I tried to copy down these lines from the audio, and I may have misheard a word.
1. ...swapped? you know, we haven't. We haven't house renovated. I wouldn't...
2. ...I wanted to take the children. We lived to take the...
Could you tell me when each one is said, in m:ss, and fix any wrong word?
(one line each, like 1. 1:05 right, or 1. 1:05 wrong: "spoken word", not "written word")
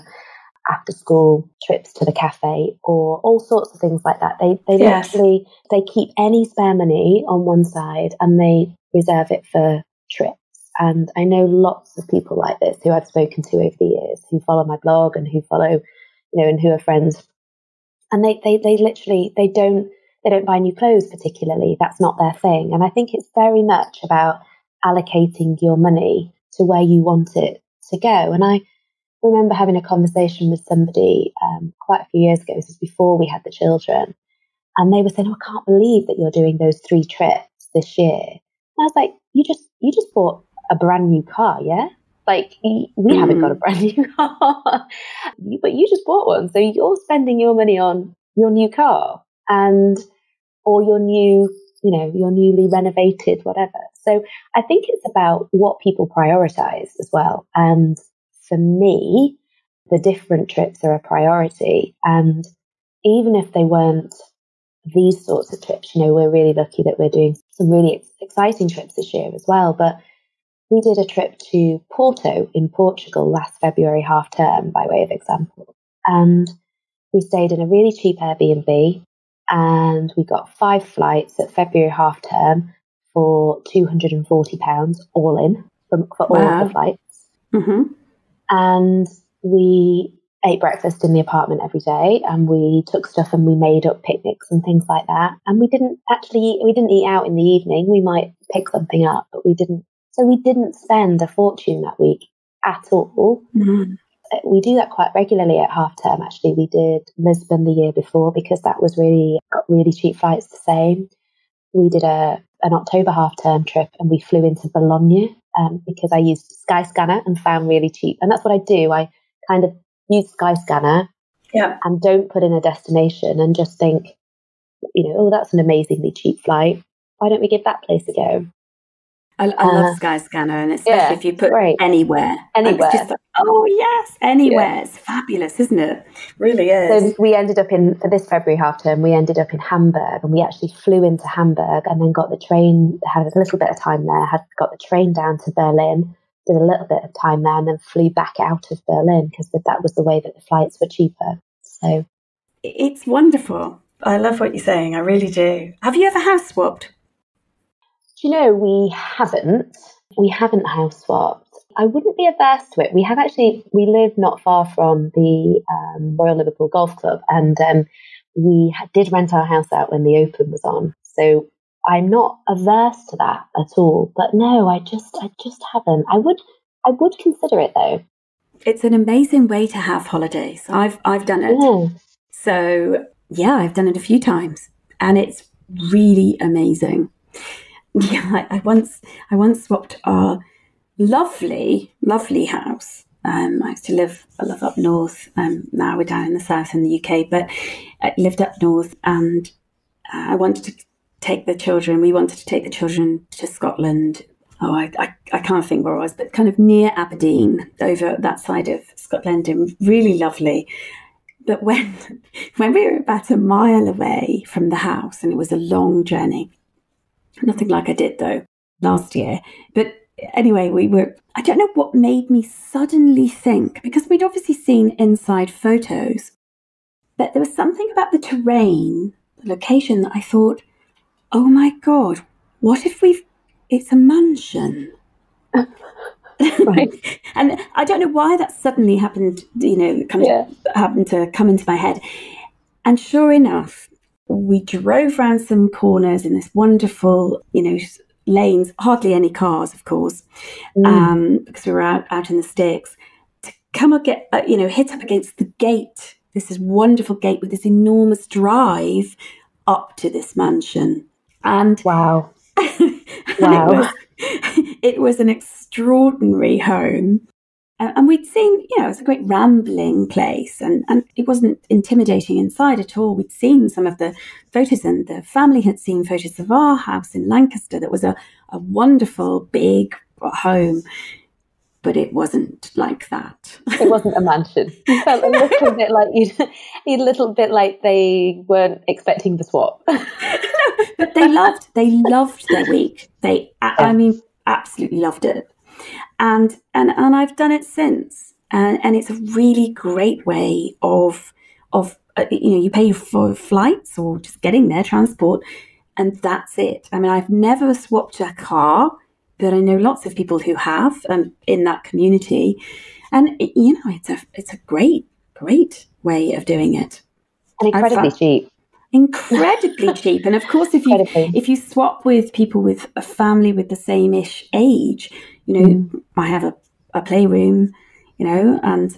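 1. 2:36 wrong: "swapped", not "renovated"
2. 3:20 wrong: "wanted", not "lived".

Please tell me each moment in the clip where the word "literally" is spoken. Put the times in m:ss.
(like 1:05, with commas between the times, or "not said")
0:05, 0:18.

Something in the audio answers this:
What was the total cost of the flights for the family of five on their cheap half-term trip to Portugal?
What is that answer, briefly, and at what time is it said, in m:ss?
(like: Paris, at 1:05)
£240, at 1:23.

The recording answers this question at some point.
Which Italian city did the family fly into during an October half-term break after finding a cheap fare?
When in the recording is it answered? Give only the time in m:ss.
1:54.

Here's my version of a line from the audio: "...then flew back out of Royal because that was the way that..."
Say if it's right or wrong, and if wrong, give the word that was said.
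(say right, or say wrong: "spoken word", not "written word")
wrong: "Berlin", not "Royal".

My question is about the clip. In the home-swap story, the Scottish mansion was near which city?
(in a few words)
Aberdeen.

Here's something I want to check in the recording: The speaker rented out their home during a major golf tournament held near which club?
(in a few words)
Royal Liverpool Golf Club.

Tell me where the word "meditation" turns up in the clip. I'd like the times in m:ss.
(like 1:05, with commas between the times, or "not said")
not said.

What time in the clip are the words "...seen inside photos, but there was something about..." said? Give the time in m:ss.
3:44.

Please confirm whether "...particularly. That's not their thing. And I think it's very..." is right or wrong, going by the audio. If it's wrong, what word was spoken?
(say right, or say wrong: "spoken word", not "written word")
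right.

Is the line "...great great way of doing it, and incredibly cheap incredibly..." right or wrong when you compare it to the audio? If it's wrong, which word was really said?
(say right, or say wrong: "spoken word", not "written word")
right.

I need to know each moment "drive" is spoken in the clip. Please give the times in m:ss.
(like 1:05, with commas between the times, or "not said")
4:18.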